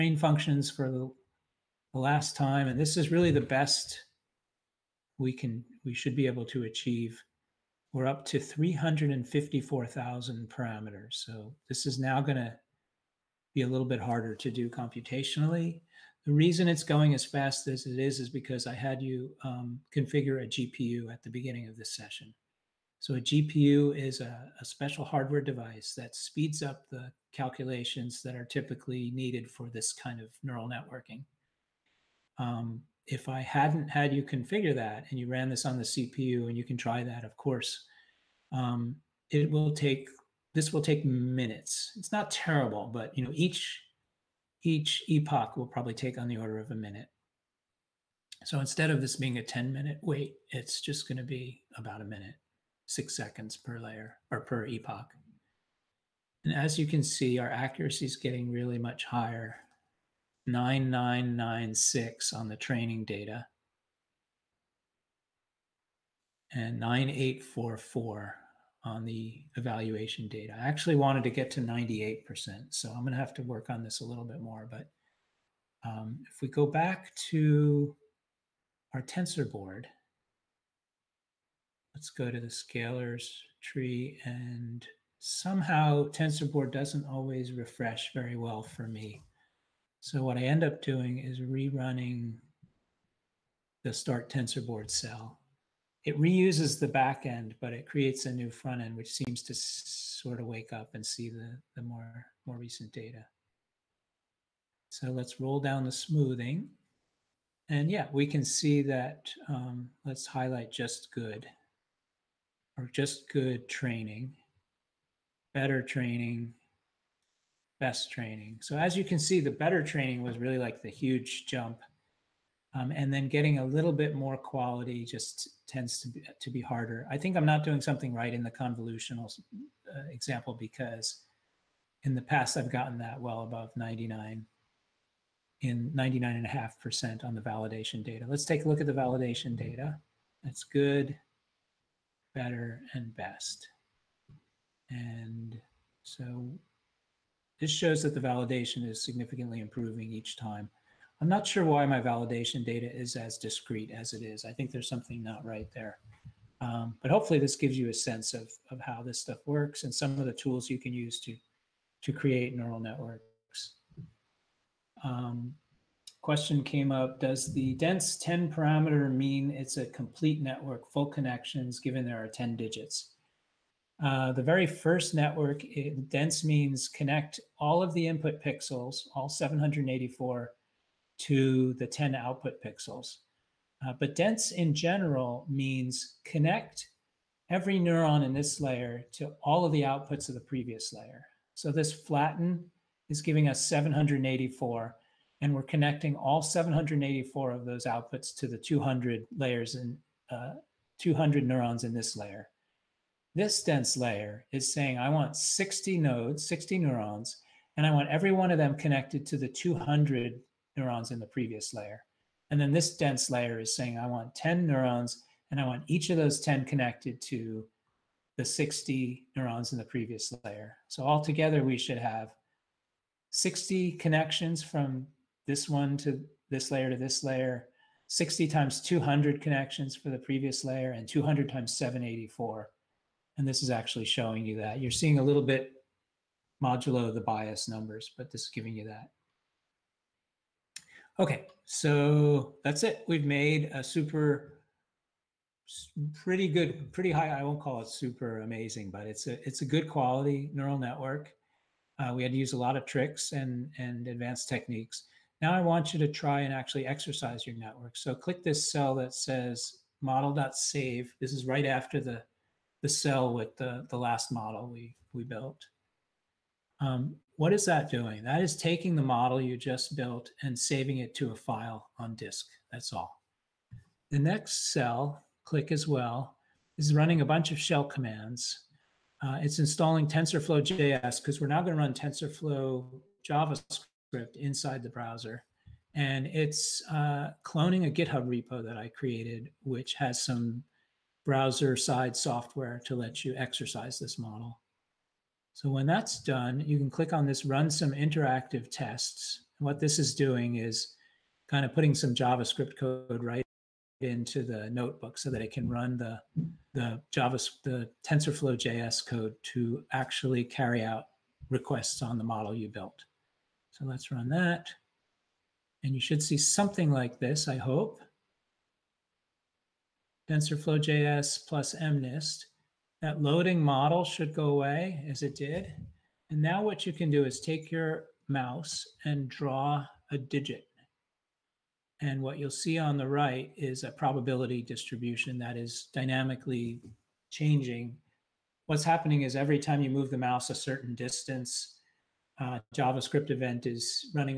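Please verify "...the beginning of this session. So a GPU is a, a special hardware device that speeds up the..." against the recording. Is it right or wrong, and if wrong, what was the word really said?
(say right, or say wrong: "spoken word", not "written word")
right.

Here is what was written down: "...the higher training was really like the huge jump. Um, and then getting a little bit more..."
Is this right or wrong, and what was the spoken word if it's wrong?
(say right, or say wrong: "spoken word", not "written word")
wrong: "better", not "higher".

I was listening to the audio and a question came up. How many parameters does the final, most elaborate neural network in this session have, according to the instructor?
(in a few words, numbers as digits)
354,000.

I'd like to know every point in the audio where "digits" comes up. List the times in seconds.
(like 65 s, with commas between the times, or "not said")
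172 s, 330 s.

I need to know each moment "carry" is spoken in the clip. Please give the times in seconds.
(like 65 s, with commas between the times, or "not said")
310 s.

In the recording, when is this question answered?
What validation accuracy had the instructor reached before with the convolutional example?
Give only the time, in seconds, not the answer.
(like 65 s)
135 s.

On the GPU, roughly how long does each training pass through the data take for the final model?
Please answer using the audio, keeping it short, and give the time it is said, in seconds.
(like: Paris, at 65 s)
six seconds, at 52 s.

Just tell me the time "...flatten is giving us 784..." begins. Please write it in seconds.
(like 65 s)
191 s.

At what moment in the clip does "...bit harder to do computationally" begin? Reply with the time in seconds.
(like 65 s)
13 s.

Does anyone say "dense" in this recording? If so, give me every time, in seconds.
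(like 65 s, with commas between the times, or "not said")
167 s, 176 s, 184 s, 203 s, 212 s.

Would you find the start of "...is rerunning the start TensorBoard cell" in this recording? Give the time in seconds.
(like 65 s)
91 s.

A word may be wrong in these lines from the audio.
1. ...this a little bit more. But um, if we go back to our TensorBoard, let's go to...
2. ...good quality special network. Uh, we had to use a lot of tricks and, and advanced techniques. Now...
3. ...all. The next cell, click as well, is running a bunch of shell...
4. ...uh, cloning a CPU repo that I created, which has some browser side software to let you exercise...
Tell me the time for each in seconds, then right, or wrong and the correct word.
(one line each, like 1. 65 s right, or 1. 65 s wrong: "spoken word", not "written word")
1. 73 s right
2. 249 s wrong: "neural", not "special"
3. 272 s right
4. 286 s wrong: "GitHub", not "CPU".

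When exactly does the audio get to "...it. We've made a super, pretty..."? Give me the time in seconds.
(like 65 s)
242 s.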